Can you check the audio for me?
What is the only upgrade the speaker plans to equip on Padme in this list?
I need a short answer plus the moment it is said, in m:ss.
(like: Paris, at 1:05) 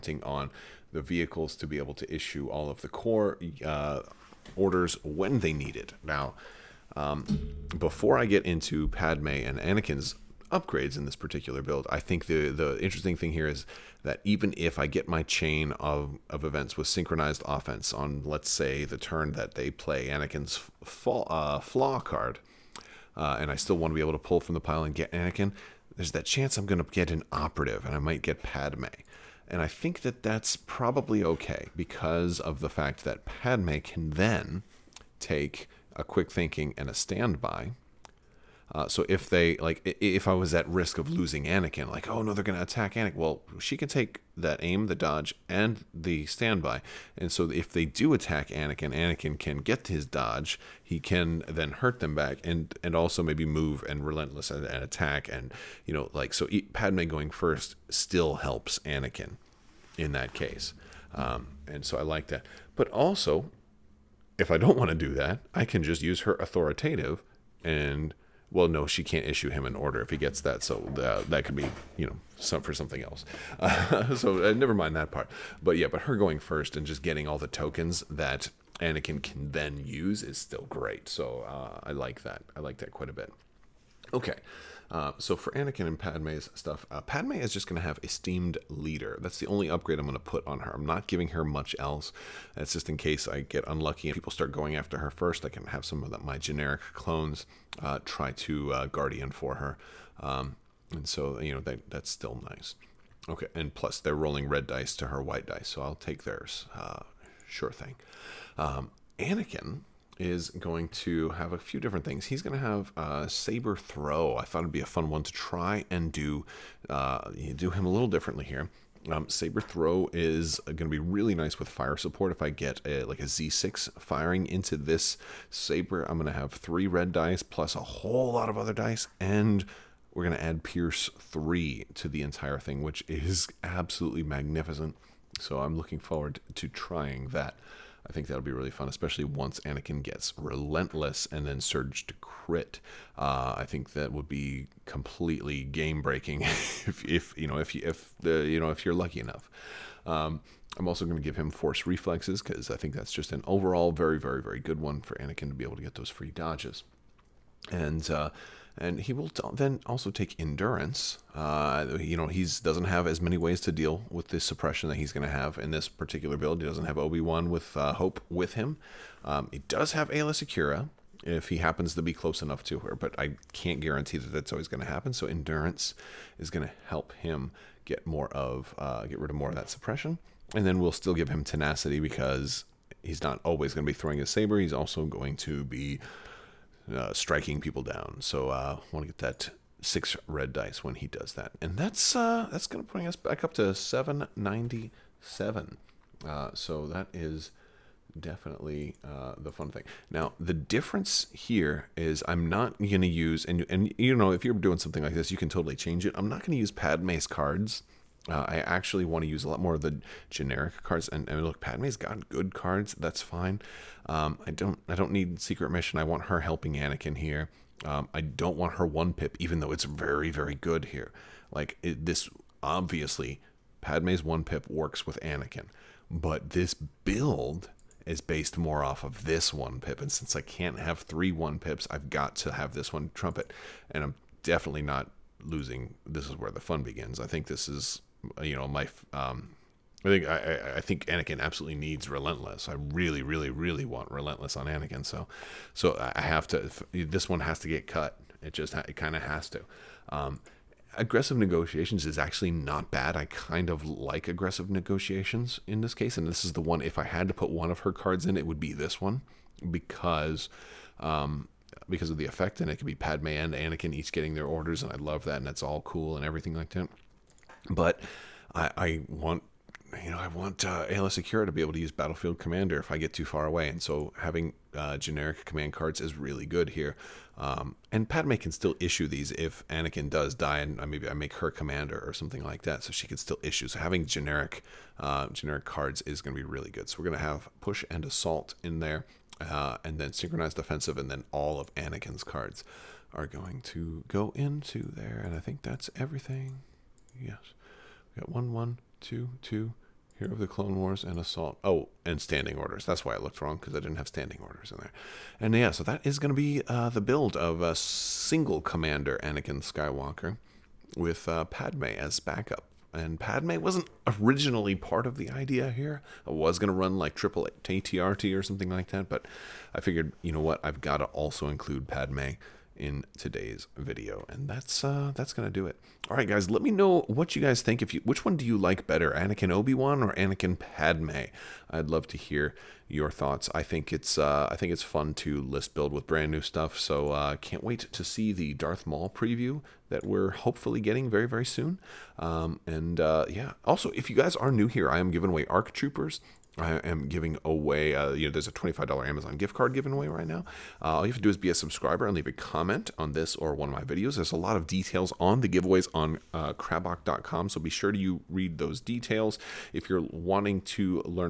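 Esteemed Leader, at 1:28.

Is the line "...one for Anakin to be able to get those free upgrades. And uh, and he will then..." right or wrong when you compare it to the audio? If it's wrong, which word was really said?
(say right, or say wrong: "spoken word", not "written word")
wrong: "dodges", not "upgrades".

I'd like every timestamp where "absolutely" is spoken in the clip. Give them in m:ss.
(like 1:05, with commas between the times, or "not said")
2:13, 4:01.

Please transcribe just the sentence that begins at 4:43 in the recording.
So having generic uh, generic cards is going to be really good.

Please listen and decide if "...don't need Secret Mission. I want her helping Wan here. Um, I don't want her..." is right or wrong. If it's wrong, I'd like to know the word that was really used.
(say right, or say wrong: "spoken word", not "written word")
wrong: "Anakin", not "Wan".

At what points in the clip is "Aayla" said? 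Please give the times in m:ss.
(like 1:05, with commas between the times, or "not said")
2:50, 4:30.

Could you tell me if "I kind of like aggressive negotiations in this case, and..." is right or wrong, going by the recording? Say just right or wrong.
right.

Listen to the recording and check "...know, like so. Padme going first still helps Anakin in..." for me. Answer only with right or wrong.
right.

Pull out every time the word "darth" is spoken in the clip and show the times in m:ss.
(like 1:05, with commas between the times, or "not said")
5:38.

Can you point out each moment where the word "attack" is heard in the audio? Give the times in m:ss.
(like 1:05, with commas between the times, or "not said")
0:42, 0:48, 0:54.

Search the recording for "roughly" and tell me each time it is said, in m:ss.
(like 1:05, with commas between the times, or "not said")
not said.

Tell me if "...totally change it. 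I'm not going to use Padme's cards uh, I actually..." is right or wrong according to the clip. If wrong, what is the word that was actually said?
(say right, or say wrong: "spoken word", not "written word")
right.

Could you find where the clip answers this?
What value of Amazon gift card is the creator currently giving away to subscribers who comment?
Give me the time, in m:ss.
5:48.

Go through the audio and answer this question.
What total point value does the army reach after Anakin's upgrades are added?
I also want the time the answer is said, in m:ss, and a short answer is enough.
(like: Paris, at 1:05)
797, at 3:13.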